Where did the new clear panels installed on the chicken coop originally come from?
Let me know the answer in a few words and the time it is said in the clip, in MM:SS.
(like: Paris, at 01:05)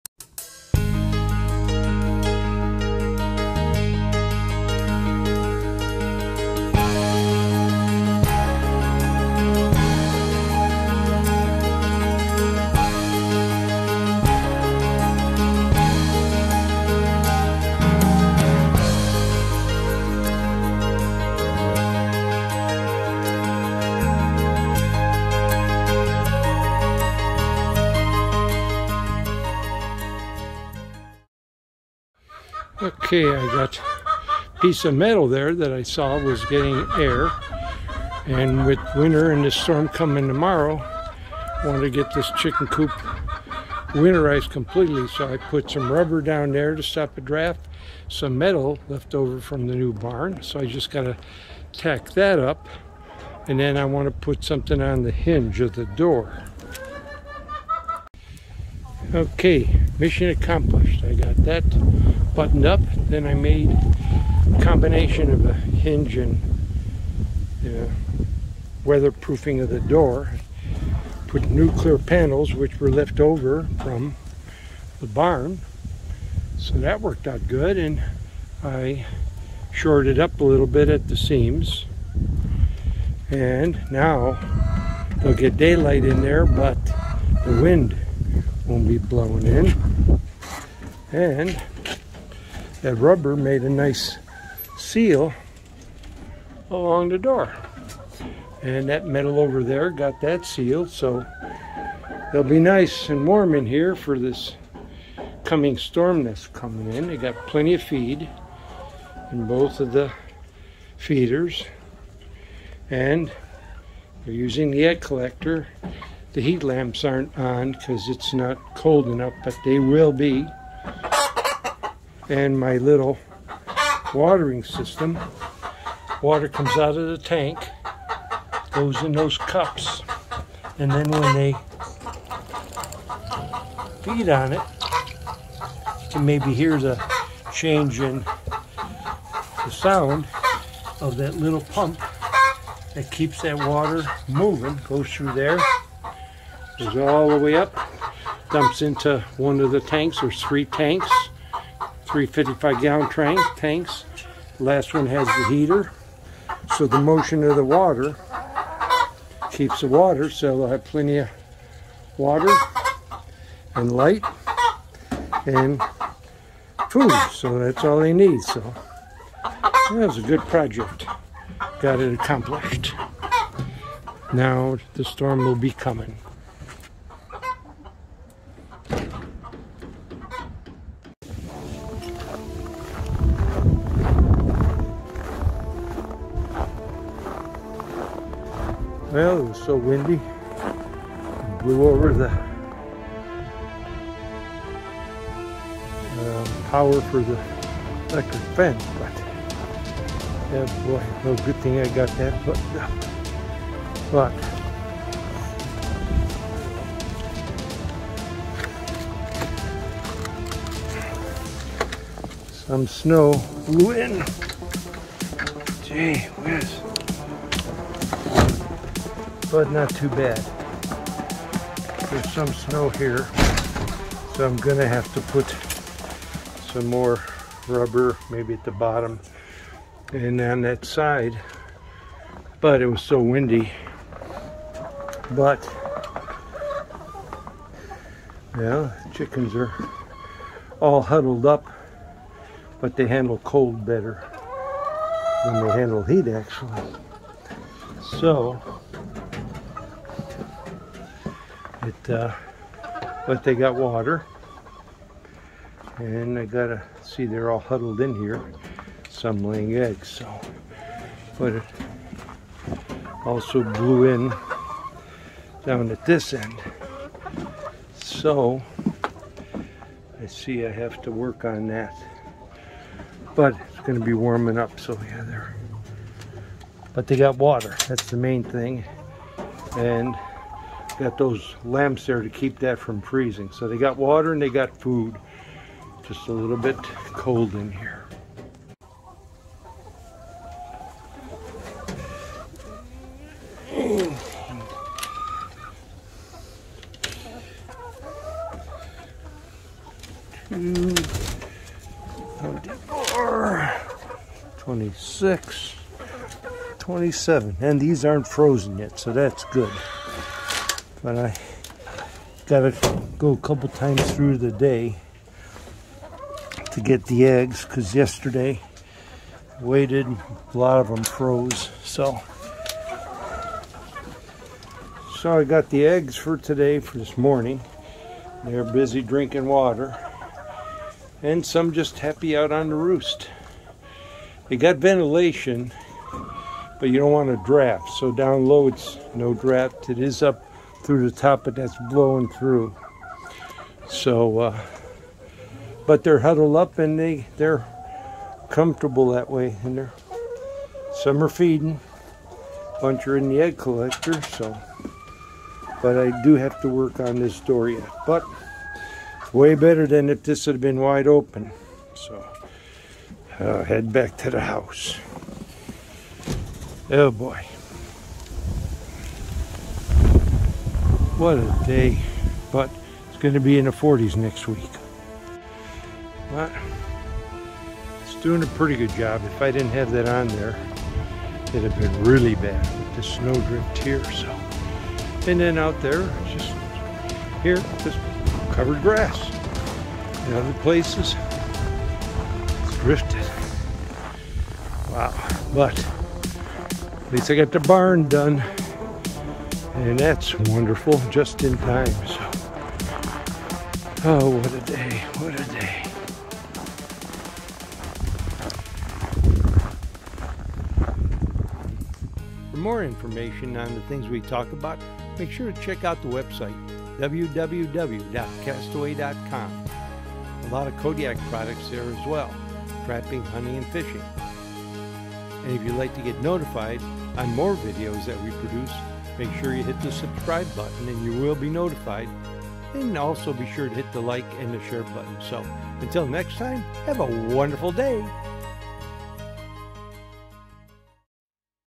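Left over from the barn, at 01:12.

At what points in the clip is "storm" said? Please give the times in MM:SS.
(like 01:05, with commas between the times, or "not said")
00:39, 01:45, 02:55.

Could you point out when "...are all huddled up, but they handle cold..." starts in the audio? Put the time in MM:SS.
03:59.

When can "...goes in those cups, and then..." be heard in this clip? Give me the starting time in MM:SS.
02:08.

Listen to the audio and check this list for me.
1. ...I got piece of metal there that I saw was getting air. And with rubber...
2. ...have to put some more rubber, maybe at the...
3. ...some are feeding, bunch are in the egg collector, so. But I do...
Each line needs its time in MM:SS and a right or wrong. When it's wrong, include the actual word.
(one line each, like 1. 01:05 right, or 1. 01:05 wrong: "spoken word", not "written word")
1. 00:33 wrong: "winter", not "rubber"
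2. 03:44 right
3. 05:51 right.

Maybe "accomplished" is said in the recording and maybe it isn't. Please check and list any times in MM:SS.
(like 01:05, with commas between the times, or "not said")
01:00, 02:52.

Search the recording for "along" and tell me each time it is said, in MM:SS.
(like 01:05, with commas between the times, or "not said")
01:36.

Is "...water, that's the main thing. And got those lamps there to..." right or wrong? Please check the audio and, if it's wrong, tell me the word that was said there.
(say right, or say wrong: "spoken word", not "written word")
right.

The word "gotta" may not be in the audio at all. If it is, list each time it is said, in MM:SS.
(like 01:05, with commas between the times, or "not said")
04:16, 05:12.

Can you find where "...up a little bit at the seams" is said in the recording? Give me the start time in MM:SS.
01:20.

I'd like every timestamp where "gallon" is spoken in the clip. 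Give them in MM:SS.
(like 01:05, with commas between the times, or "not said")
02:32.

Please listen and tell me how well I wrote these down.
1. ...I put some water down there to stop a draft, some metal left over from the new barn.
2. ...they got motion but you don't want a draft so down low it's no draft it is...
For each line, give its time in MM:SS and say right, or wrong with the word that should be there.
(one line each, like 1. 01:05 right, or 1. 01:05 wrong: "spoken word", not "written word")
1. 00:45 wrong: "rubber", not "water"
2. 05:34 wrong: "ventilation", not "motion".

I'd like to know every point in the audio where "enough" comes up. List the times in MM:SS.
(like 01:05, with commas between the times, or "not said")
01:59.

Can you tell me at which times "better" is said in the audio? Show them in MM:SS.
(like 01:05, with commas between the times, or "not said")
04:03, 05:59.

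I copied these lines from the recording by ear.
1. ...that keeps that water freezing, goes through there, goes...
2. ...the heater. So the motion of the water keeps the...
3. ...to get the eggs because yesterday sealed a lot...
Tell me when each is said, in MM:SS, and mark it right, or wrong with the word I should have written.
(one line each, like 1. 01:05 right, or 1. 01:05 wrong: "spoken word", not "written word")
1. 02:22 wrong: "moving", not "freezing"
2. 02:35 right
3. 05:16 wrong: "waited", not "sealed".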